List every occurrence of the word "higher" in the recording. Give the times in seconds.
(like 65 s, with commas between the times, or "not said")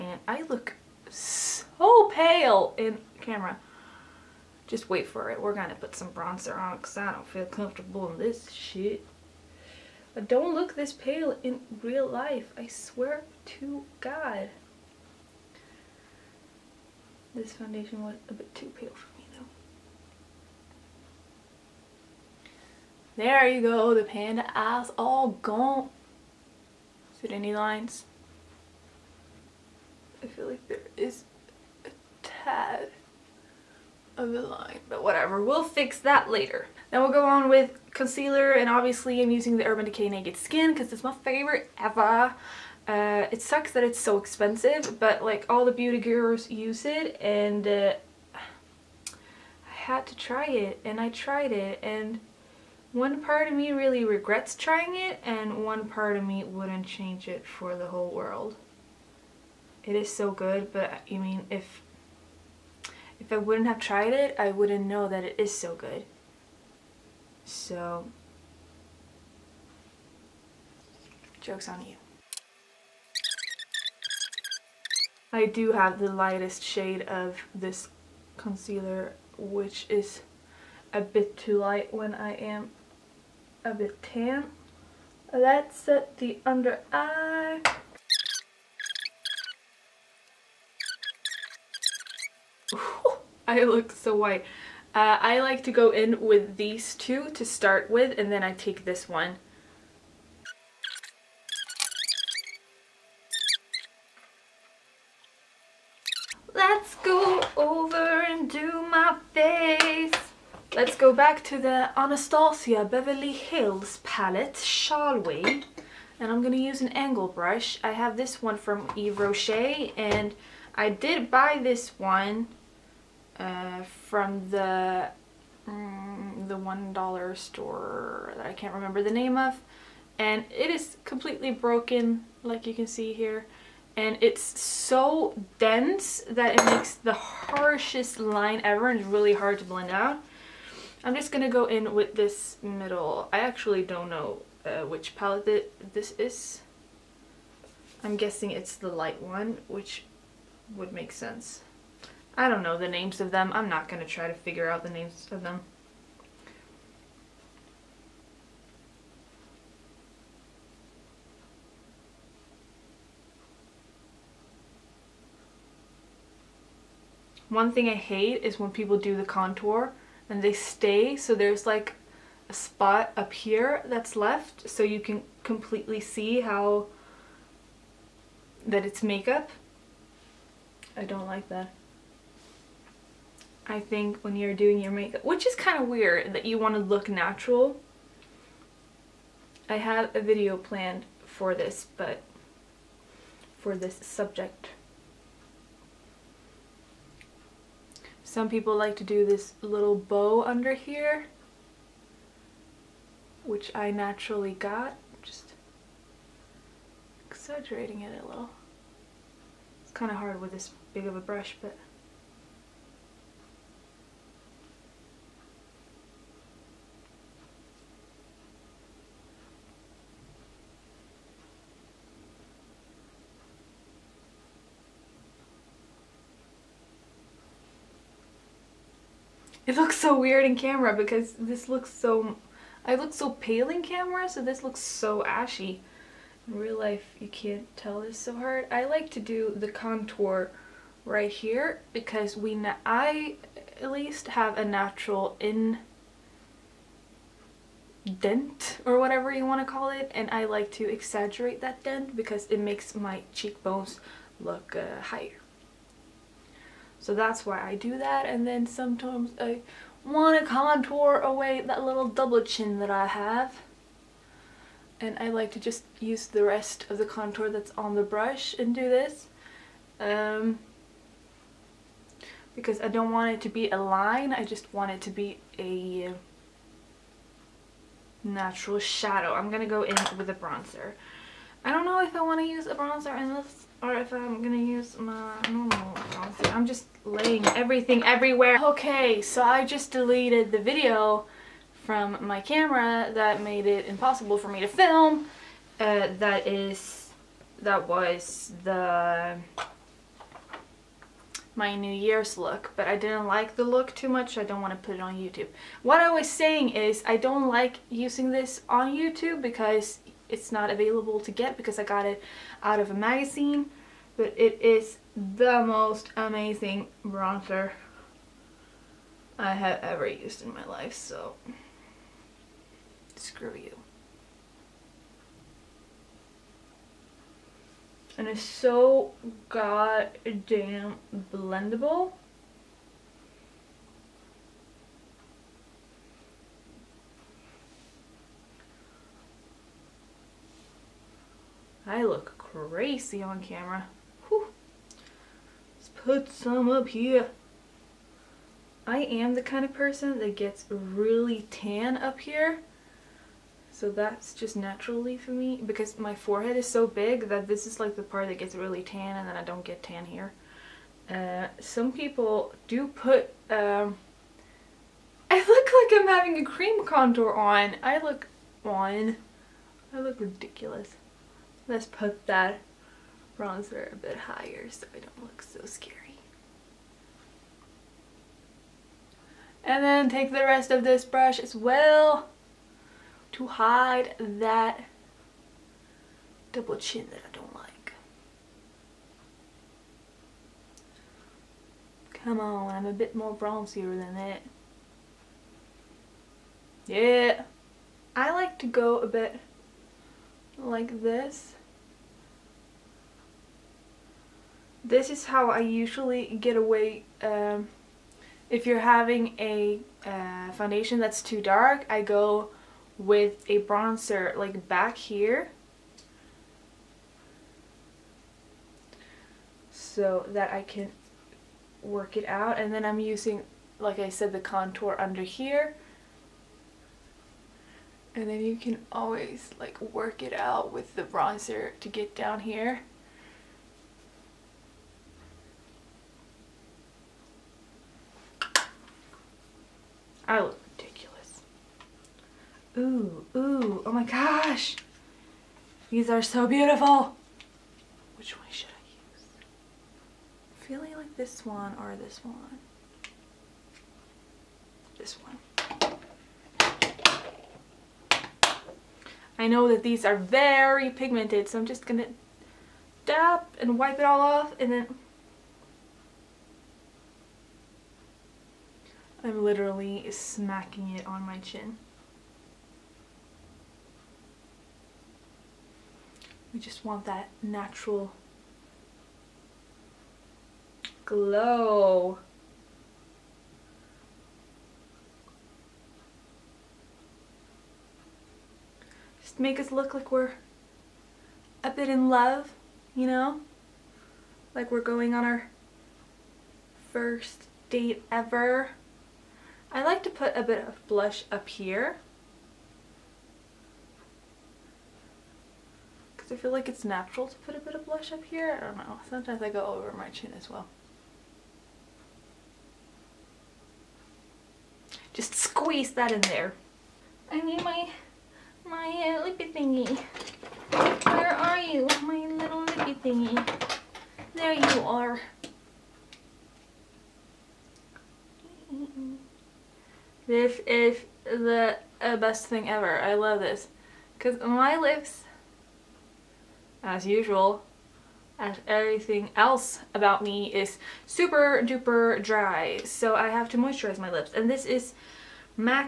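255 s, 374 s.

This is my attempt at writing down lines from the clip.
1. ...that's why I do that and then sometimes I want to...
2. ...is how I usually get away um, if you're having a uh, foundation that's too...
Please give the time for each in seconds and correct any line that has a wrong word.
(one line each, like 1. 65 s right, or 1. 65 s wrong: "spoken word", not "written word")
1. 257 s right
2. 405 s right.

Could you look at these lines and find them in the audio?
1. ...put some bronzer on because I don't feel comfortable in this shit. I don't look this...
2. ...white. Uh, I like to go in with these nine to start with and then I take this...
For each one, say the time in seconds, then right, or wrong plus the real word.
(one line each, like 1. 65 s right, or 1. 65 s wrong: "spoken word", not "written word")
1. 5 s right
2. 94 s wrong: "two", not "nine".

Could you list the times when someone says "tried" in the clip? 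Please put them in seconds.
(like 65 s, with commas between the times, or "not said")
51 s, 63 s.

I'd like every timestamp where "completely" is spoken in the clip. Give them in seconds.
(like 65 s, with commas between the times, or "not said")
131 s, 175 s.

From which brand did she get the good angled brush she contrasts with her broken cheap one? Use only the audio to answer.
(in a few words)
Yves Rocher.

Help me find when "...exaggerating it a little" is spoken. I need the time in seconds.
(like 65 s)
207 s.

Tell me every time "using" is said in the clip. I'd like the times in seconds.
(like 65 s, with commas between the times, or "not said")
39 s, 307 s, 422 s.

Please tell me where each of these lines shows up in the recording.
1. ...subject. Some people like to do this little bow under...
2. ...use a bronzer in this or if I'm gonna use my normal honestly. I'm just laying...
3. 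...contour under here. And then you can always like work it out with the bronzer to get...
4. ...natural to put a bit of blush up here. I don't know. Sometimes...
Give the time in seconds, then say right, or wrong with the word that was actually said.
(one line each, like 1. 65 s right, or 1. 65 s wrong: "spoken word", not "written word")
1. 194 s right
2. 282 s right
3. 424 s right
4. 506 s right.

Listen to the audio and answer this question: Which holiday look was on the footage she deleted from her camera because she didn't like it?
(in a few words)
New Year's.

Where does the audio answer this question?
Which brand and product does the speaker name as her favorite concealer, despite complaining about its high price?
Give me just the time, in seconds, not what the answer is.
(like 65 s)
39 s.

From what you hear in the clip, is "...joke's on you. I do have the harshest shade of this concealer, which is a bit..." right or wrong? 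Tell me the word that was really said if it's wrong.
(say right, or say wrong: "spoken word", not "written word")
wrong: "lightest", not "harshest".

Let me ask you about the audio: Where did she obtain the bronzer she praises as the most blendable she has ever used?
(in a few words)
a magazine.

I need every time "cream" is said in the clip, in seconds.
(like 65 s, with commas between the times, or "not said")
366 s.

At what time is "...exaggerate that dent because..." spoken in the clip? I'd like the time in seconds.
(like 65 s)
250 s.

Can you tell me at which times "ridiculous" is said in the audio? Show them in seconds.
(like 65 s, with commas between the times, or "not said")
370 s, 440 s.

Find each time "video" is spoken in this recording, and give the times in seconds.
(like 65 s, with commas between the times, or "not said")
190 s, 290 s.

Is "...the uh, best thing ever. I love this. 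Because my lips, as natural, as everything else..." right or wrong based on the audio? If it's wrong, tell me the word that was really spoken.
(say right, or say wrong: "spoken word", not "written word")
wrong: "usual", not "natural".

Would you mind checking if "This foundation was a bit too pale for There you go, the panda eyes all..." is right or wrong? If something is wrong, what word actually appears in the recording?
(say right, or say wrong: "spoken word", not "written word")
right.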